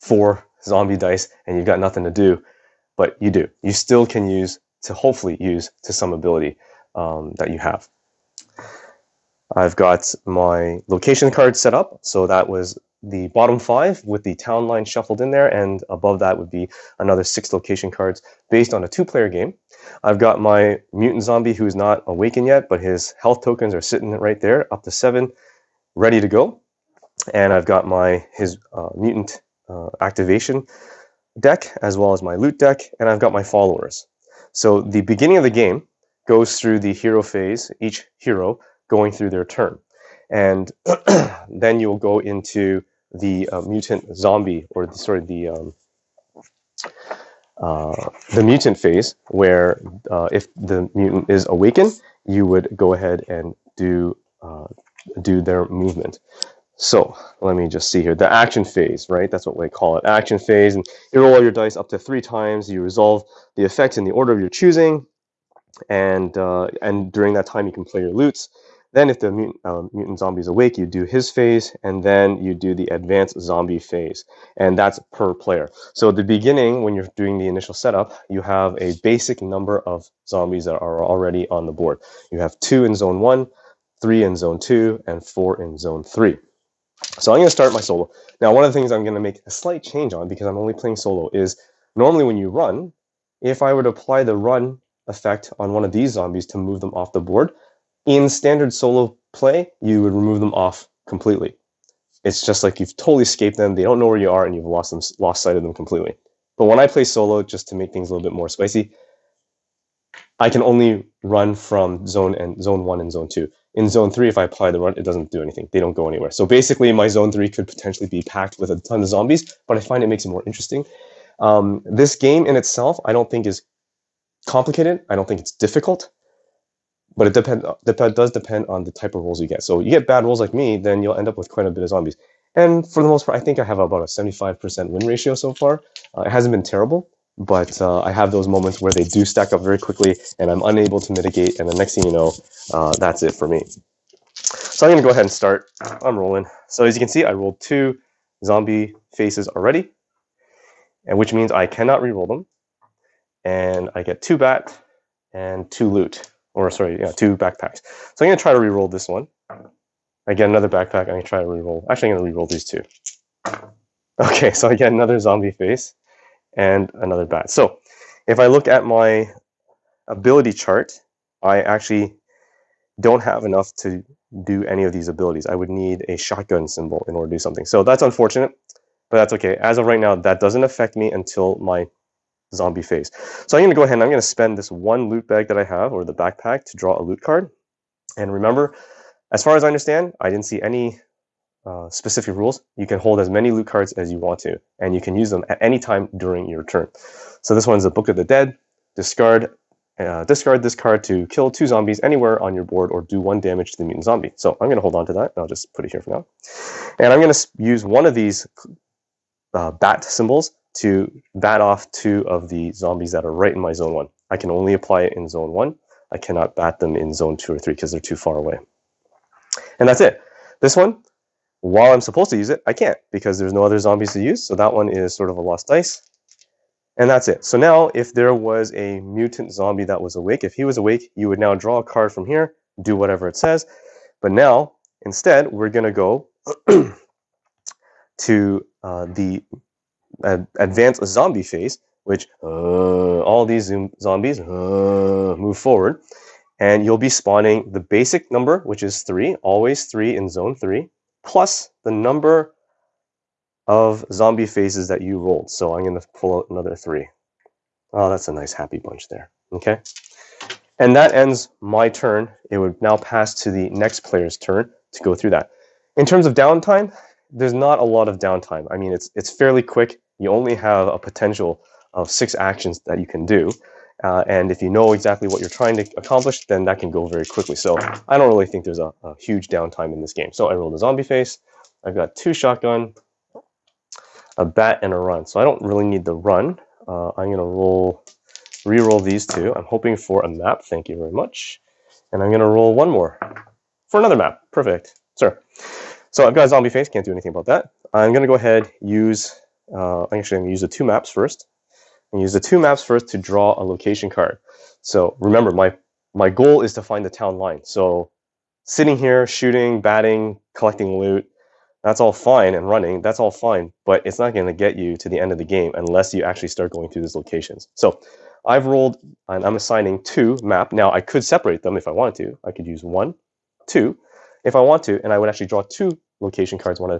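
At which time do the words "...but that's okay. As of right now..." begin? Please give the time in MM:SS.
02:59.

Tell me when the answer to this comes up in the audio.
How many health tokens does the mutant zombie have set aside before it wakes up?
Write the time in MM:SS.
00:24.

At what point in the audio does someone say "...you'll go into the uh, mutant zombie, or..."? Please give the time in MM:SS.
00:41.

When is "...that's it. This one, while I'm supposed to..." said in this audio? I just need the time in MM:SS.
03:39.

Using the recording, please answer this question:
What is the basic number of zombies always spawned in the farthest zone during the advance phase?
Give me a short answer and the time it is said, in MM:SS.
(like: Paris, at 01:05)
3, at 04:09.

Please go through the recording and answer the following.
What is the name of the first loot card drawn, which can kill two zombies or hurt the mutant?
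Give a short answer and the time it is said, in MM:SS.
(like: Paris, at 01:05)
Book of the Dead, at 03:17.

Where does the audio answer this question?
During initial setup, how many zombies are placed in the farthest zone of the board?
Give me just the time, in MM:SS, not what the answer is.
01:25.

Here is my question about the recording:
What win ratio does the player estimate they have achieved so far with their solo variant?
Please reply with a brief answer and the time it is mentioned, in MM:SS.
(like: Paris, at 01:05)
75%, at 02:14.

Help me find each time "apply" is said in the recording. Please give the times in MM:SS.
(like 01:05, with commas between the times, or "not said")
01:33, 01:54, 03:34.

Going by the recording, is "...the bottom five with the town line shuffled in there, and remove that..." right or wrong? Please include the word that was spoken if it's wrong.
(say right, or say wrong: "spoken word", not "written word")
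wrong: "above", not "remove".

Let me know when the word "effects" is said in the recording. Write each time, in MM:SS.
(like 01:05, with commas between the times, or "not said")
01:03, 01:35.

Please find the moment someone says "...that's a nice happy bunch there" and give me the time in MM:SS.
04:18.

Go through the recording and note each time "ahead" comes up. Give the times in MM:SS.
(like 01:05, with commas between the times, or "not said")
00:52, 02:25, 03:03, 04:58.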